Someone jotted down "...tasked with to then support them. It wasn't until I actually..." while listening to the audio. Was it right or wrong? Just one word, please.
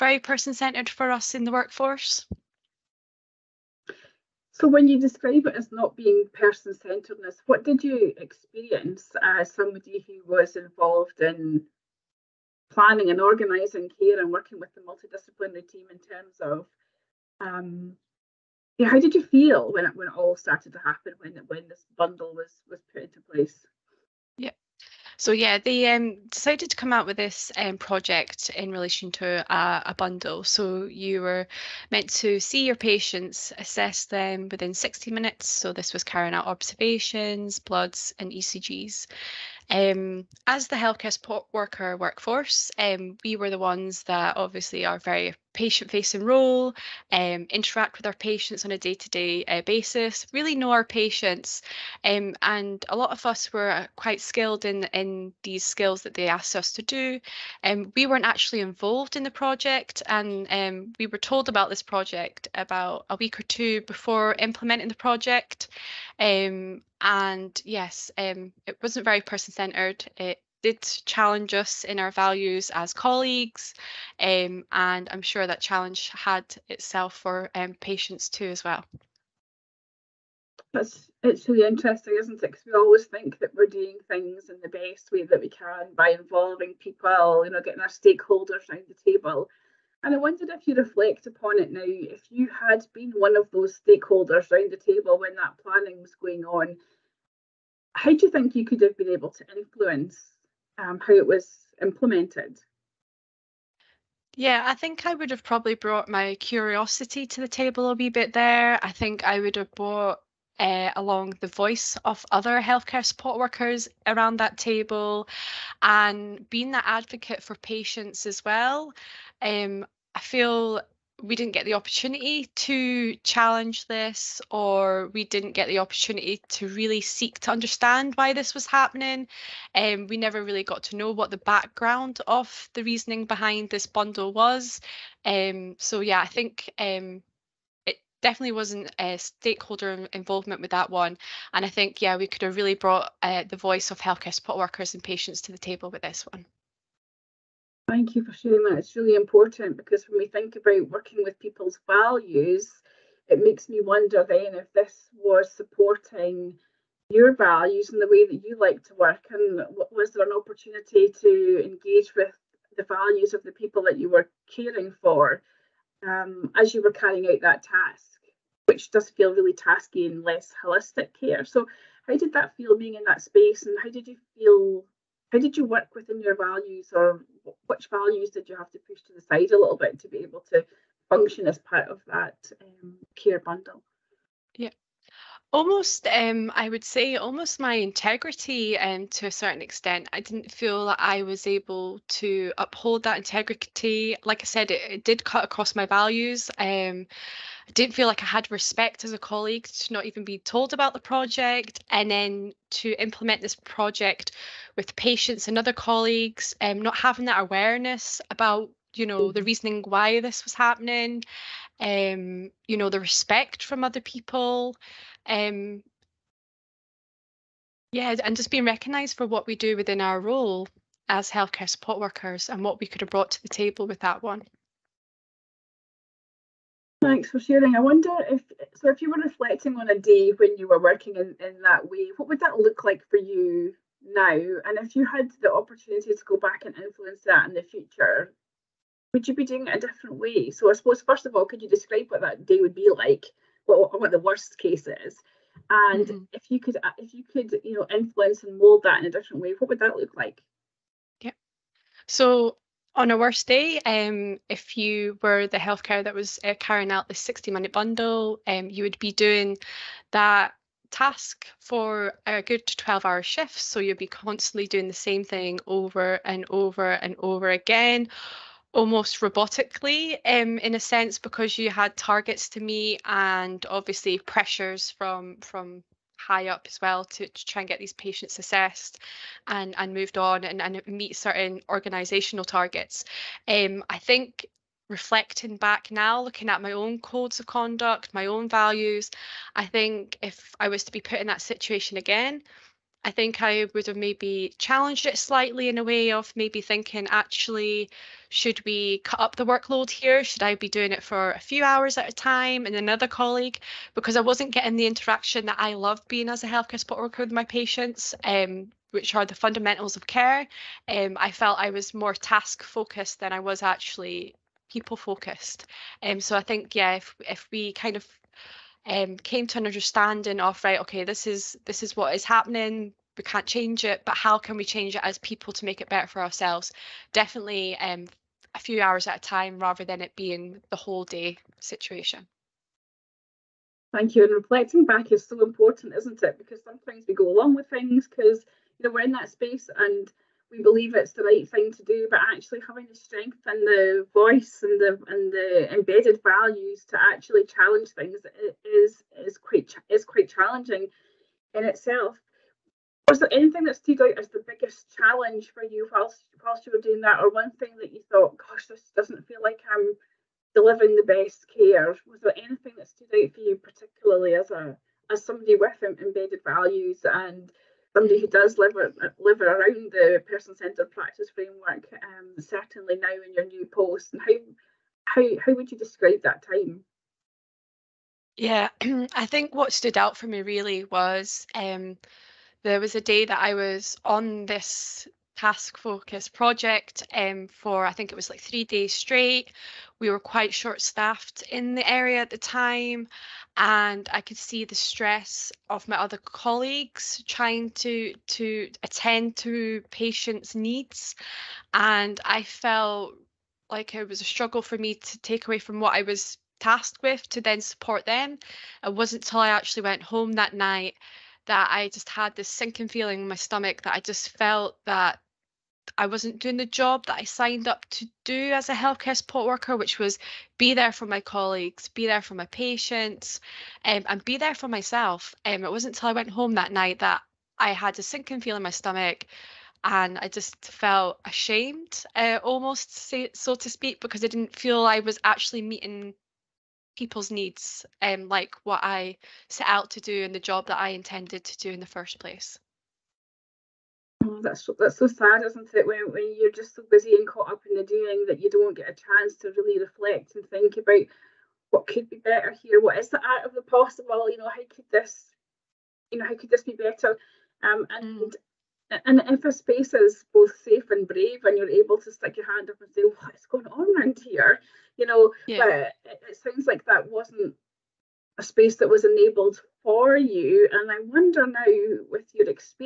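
right.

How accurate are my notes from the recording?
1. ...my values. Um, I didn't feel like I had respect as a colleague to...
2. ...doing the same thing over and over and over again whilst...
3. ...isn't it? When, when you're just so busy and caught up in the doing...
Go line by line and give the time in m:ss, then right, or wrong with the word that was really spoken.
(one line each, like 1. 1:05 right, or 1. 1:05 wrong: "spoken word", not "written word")
1. 3:15 right
2. 4:24 wrong: "almost", not "whilst"
3. 7:25 right.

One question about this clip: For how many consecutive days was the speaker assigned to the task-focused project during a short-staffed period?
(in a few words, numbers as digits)
three days.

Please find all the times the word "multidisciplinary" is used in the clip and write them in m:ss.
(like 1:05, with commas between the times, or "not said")
0:14.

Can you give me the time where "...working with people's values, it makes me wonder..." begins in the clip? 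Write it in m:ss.
2:30.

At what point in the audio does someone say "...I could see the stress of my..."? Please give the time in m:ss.
6:34.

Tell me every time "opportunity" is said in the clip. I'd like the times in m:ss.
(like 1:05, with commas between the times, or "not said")
2:01, 2:05, 2:40, 3:55.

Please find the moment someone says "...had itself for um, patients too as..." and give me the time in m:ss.
1:16.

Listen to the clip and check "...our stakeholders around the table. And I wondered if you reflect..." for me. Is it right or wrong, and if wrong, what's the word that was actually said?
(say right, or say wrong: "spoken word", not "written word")
right.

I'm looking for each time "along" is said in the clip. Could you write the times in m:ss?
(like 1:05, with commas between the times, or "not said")
1:50, 5:37.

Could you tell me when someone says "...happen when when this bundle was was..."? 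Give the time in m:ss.
0:20.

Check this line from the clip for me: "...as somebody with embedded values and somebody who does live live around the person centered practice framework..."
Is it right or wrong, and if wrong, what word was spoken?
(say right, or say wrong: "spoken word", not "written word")
right.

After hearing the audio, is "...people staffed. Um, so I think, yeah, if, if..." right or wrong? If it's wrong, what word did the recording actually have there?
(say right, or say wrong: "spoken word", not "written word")
wrong: "focused", not "staffed".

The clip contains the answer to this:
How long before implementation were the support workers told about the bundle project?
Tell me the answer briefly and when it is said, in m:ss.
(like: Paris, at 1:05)
a week or two, at 1:03.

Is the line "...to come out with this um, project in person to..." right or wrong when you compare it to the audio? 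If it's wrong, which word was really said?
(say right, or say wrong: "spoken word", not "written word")
wrong: "relation", not "person".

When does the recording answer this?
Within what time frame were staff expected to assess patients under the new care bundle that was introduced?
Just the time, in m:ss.
0:34.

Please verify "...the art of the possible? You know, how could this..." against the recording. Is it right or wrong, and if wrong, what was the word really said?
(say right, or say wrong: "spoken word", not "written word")
right.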